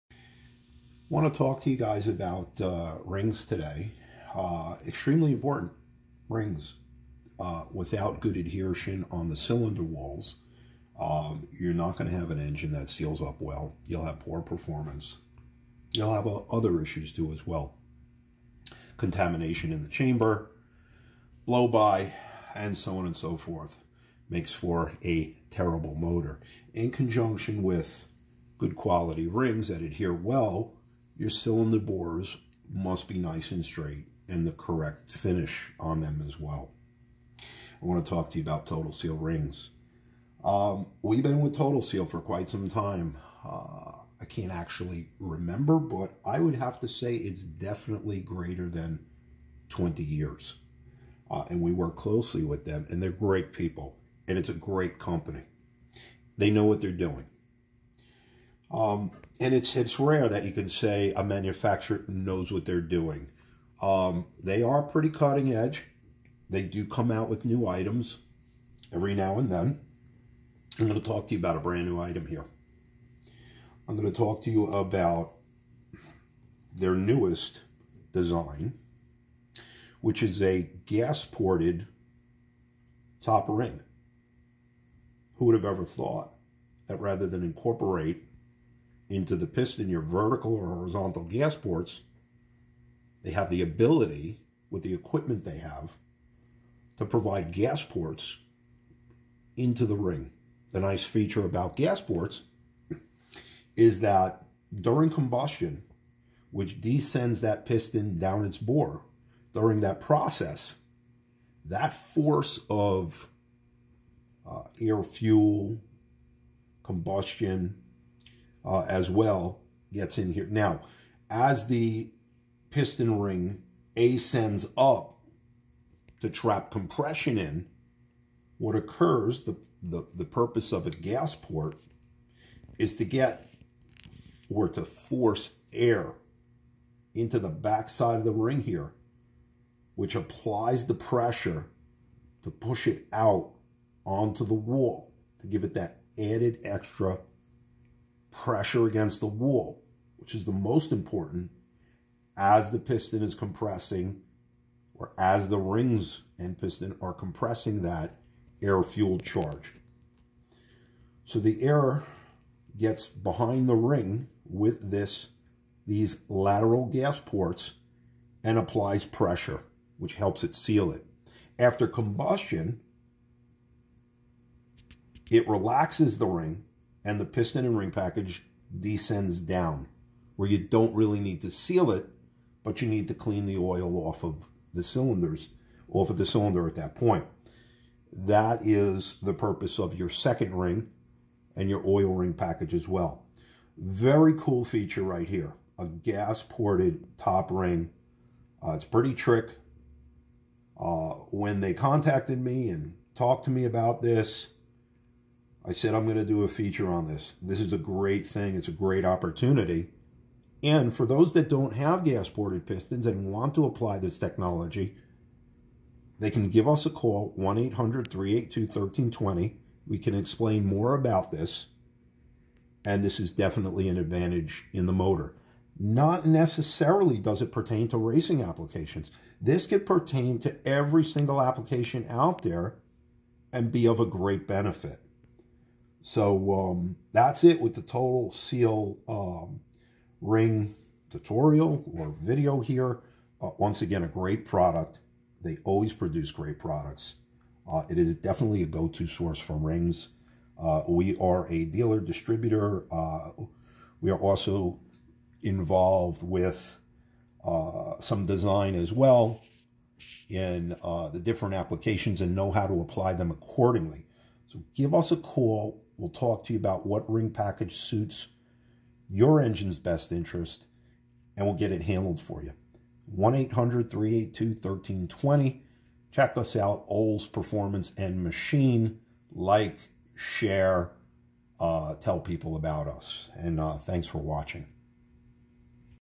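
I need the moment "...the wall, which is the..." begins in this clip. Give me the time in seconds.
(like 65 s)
149 s.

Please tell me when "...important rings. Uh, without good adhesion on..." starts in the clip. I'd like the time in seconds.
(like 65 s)
5 s.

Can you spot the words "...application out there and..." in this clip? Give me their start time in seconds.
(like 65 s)
231 s.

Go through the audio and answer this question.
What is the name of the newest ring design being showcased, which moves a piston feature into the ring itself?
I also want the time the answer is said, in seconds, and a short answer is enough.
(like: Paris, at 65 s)
gas-ported top ring, at 80 s.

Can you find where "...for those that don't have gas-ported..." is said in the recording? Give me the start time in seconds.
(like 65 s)
210 s.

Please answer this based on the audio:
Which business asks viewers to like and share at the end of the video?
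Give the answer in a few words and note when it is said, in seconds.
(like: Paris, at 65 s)
Olds Performance and Machine, at 276 s.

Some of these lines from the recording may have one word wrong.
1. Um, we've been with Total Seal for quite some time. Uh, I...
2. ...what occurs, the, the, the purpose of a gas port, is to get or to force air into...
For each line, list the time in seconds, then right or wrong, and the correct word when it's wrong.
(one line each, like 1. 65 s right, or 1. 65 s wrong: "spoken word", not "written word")
1. 40 s right
2. 128 s right.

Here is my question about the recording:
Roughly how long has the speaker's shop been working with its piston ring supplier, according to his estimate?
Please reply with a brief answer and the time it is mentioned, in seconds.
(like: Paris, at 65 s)
greater than 20 years, at 48 s.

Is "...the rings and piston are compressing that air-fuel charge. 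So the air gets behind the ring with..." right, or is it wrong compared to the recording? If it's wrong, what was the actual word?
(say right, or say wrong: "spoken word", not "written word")
right.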